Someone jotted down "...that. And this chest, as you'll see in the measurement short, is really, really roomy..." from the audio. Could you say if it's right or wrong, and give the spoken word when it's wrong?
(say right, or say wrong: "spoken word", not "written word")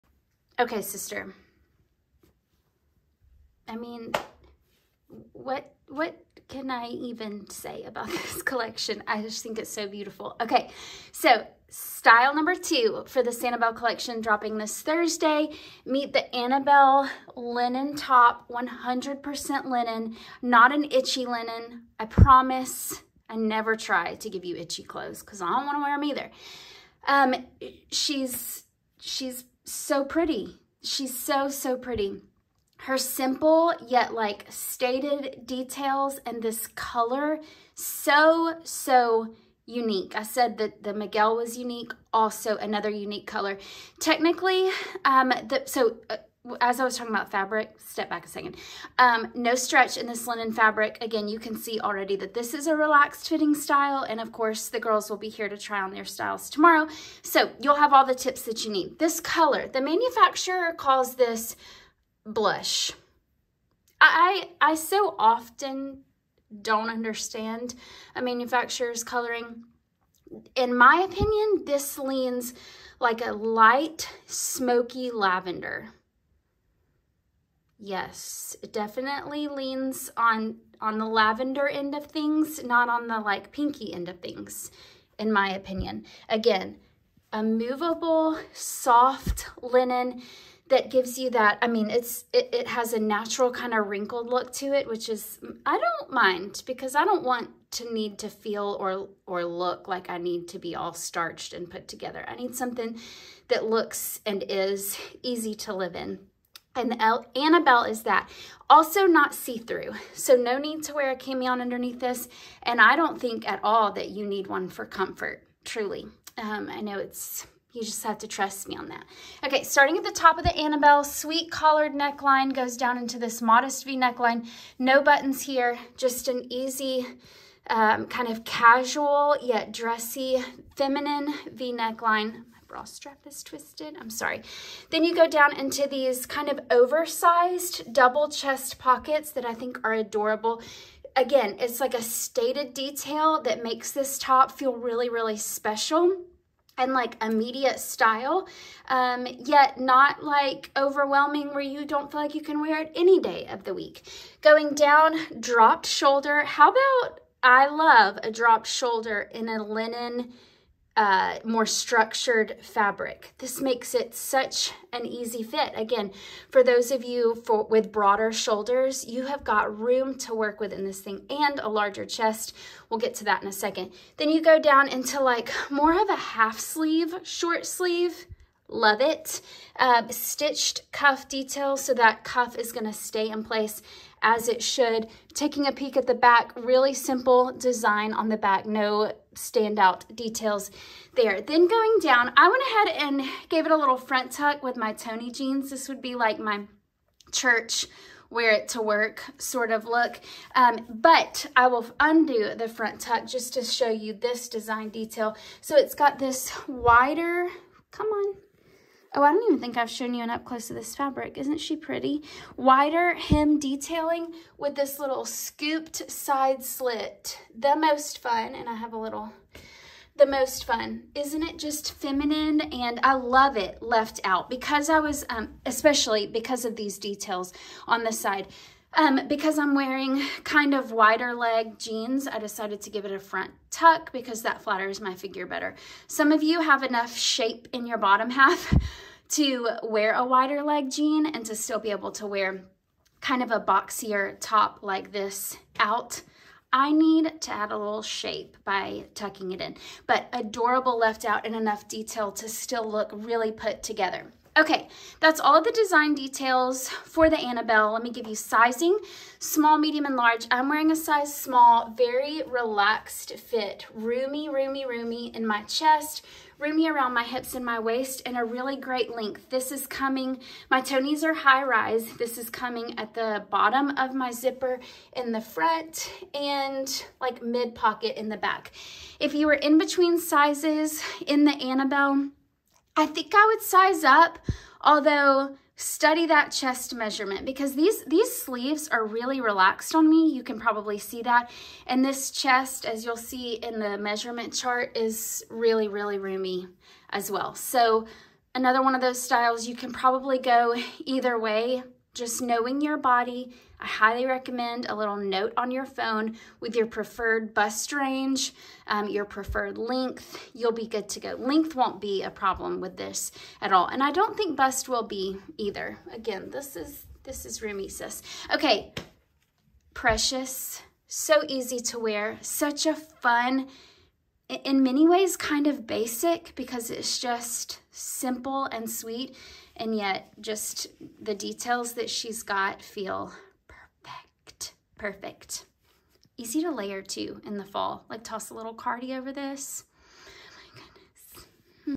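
wrong: "chart", not "short".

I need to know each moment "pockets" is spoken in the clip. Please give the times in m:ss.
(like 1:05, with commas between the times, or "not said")
2:18, 4:37.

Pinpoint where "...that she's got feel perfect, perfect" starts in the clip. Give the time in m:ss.
5:31.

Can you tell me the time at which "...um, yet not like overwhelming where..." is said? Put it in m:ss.
2:28.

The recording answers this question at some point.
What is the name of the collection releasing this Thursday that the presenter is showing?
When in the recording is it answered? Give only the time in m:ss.
0:13.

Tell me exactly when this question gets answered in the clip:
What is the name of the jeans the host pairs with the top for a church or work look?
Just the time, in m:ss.
3:14.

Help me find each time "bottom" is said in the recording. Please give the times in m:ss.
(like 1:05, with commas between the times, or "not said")
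3:57, 4:33.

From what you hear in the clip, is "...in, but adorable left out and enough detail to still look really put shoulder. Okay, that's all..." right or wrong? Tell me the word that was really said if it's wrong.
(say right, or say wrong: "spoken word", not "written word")
wrong: "together", not "shoulder".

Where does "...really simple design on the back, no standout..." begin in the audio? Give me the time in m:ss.
3:06.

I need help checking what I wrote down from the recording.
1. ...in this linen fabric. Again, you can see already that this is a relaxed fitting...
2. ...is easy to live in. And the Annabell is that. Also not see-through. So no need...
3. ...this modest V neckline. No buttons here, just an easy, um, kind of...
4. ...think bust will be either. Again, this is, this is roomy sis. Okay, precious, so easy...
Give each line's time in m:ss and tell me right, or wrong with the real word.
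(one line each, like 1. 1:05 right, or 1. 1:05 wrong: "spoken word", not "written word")
1. 0:49 right
2. 1:44 right
3. 2:03 right
4. 5:14 right.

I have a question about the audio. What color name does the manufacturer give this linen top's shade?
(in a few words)
blush.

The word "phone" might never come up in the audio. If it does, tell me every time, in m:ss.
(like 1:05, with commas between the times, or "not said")
5:05.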